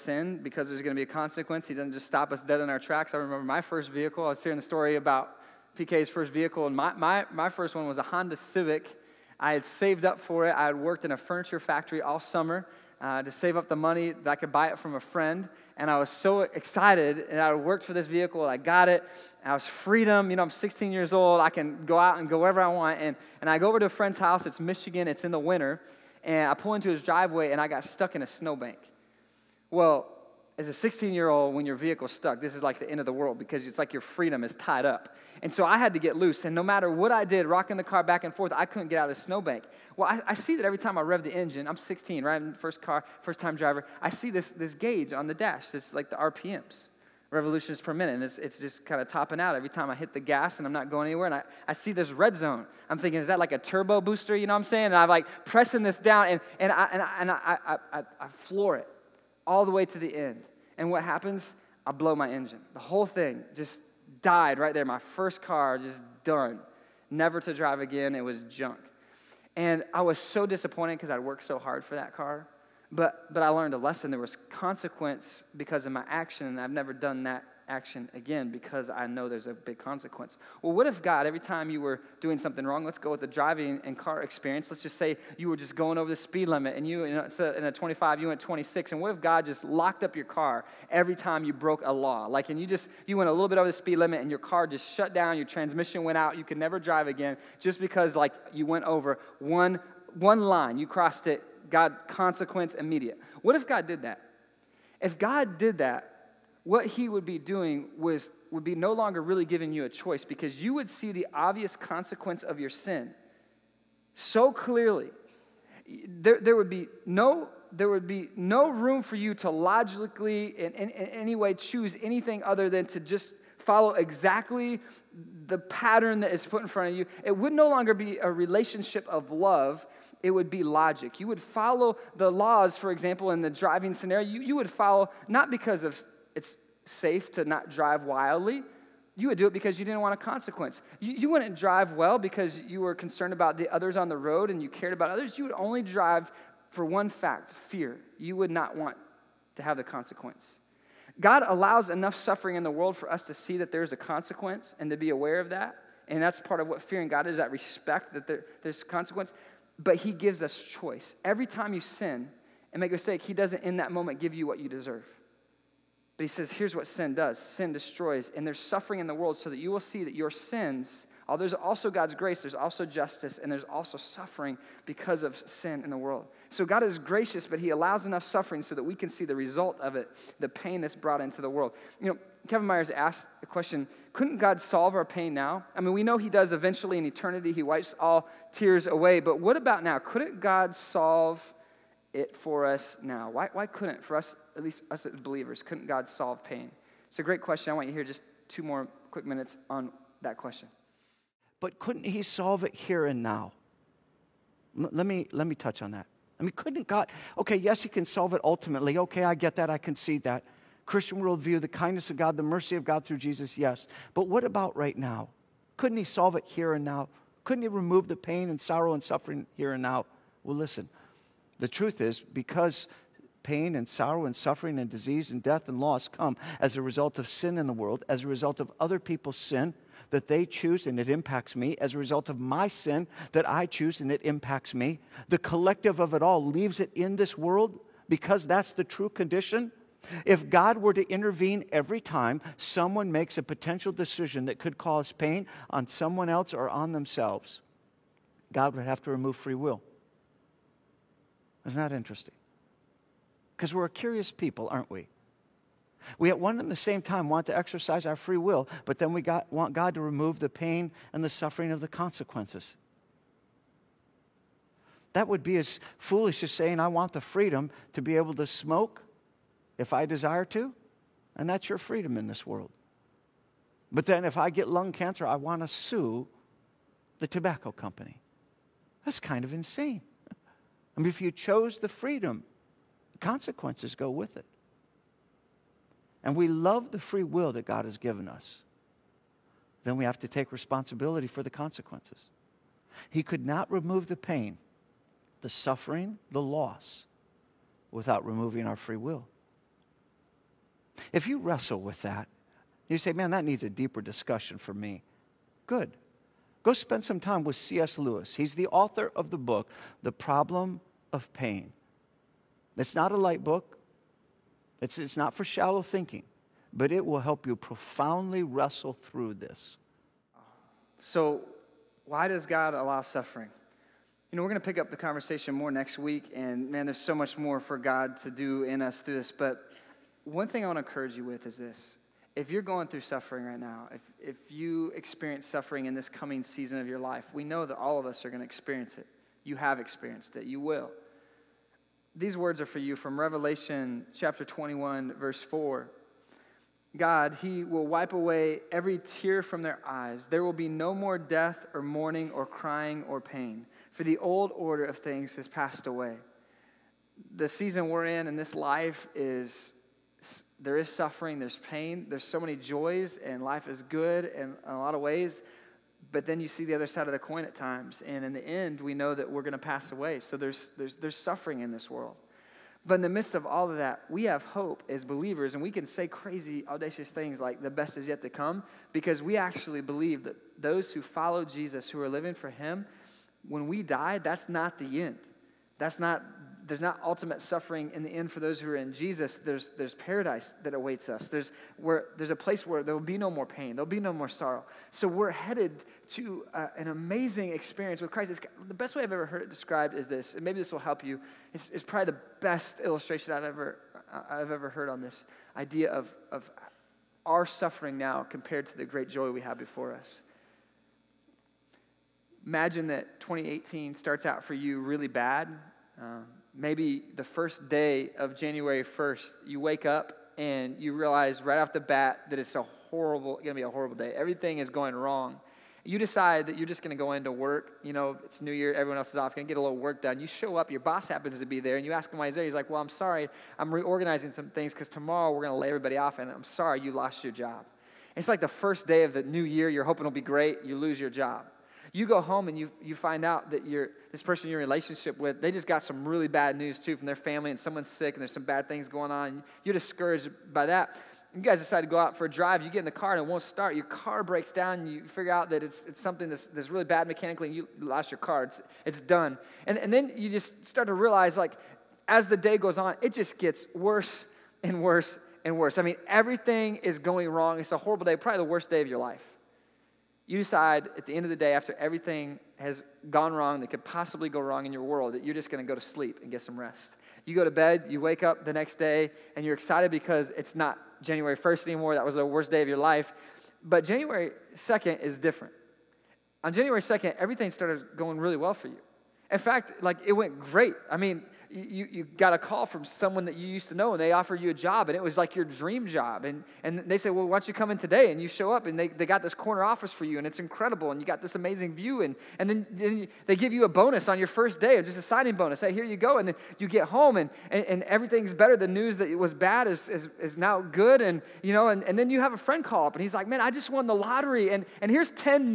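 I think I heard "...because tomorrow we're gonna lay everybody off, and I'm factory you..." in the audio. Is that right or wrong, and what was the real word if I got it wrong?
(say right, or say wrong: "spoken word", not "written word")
wrong: "sorry", not "factory".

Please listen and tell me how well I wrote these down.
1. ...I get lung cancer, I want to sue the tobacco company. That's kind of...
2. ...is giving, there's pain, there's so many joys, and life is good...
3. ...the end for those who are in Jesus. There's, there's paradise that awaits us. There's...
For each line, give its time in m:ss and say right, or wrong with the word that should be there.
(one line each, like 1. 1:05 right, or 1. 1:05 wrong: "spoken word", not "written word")
1. 4:34 right
2. 6:00 wrong: "suffering", not "giving"
3. 6:28 right.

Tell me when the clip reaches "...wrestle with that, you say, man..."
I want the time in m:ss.
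5:01.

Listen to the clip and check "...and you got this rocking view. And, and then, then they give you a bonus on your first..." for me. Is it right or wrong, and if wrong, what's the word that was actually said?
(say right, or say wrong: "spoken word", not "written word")
wrong: "amazing", not "rocking".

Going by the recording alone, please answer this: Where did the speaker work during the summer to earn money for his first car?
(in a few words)
furniture factory.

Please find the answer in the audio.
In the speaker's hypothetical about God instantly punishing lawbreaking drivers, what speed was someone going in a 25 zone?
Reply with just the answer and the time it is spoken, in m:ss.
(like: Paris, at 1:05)
26, at 1:28.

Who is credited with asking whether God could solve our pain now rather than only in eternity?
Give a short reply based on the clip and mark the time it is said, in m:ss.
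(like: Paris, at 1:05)
Kevin Myers, at 3:02.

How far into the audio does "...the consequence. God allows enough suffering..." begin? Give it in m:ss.
2:29.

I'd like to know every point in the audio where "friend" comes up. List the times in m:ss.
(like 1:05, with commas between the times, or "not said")
0:14, 0:23, 8:32.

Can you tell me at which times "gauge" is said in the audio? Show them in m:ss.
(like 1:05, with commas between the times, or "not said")
0:44.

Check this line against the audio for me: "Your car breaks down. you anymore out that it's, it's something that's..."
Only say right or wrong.
wrong.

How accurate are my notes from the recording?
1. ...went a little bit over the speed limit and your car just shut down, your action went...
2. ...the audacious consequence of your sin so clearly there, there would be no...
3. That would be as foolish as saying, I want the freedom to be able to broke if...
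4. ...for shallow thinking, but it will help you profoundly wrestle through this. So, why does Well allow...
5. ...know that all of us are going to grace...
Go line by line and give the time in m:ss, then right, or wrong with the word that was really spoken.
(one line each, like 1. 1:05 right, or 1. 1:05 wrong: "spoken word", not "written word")
1. 1:33 wrong: "transmission", not "action"
2. 1:51 wrong: "obvious", not "audacious"
3. 4:25 wrong: "smoke", not "broke"
4. 5:15 wrong: "God", not "Well"
5. 5:37 wrong: "experience", not "grace".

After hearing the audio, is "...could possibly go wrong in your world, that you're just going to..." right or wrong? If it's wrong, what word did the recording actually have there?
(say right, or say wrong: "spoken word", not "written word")
right.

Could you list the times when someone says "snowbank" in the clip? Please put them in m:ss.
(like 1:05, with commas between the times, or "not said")
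0:28, 0:39.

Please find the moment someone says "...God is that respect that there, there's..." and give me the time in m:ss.
2:37.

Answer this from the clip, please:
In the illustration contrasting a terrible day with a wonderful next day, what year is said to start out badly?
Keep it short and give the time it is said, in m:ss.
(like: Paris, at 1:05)
2018, at 6:53.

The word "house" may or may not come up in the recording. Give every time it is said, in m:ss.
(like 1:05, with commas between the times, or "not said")
0:24.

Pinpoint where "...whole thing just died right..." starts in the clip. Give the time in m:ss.
1:02.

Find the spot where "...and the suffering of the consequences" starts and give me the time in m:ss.
4:21.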